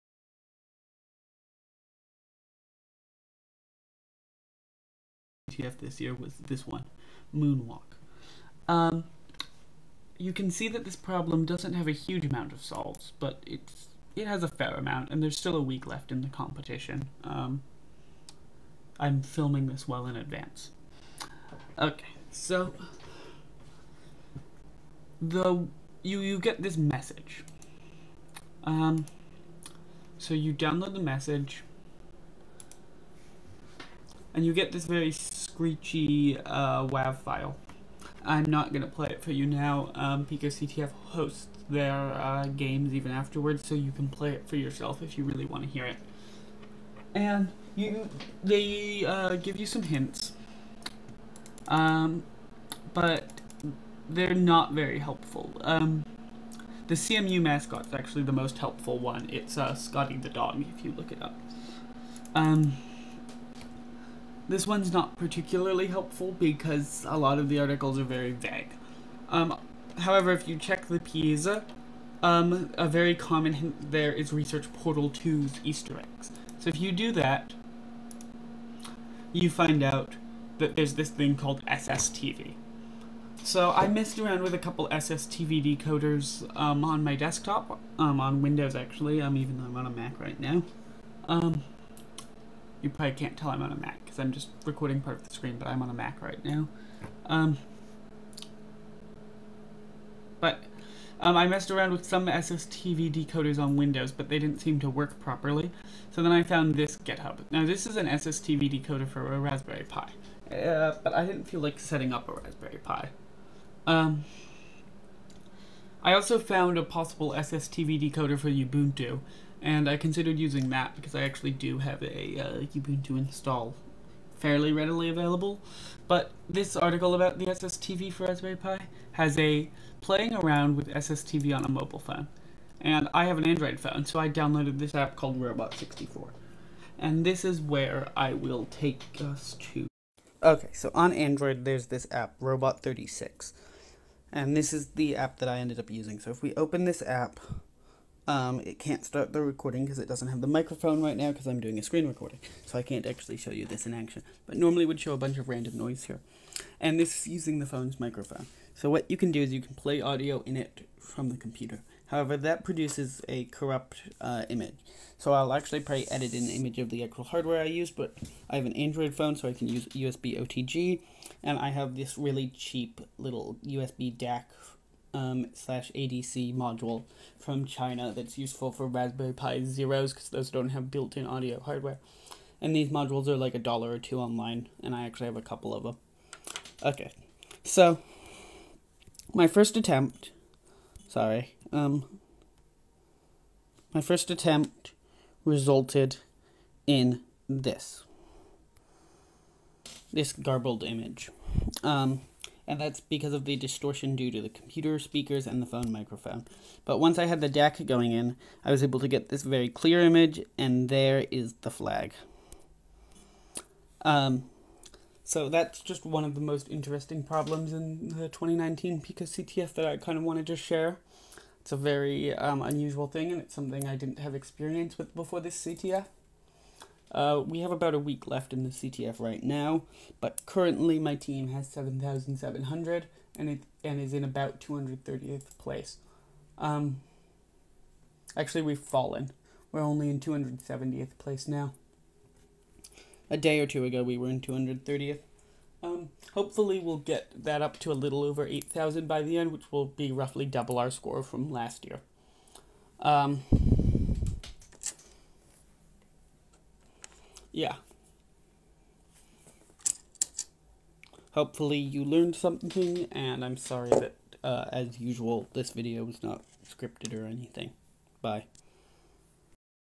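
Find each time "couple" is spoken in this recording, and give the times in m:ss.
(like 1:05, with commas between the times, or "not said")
1:24, 3:05.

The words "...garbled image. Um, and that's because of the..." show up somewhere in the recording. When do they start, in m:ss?
3:20.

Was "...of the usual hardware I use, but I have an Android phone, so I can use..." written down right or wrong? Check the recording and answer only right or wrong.
wrong.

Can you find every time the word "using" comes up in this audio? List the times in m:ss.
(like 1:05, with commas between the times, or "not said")
2:00, 2:25, 2:37.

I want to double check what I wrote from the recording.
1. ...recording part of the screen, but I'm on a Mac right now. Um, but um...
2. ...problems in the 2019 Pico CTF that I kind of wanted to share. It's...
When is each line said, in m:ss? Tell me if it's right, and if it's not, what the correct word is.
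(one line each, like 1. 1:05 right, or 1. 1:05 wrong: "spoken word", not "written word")
1. 1:34 right
2. 3:37 right.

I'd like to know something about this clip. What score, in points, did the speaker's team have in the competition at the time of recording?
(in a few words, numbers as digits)
7,700.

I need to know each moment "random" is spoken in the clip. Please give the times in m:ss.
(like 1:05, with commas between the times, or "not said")
2:35.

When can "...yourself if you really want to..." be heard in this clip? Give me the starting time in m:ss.
0:44.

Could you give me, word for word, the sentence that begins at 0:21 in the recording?
Okay, so the you you get this message.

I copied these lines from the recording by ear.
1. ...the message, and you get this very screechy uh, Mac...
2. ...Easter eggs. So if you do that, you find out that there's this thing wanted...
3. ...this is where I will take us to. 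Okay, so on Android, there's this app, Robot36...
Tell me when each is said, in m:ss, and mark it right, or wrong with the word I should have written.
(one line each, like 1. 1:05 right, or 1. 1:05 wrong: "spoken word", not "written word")
1. 0:30 wrong: "WAV", not "Mac"
2. 1:15 wrong: "called", not "wanted"
3. 2:17 right.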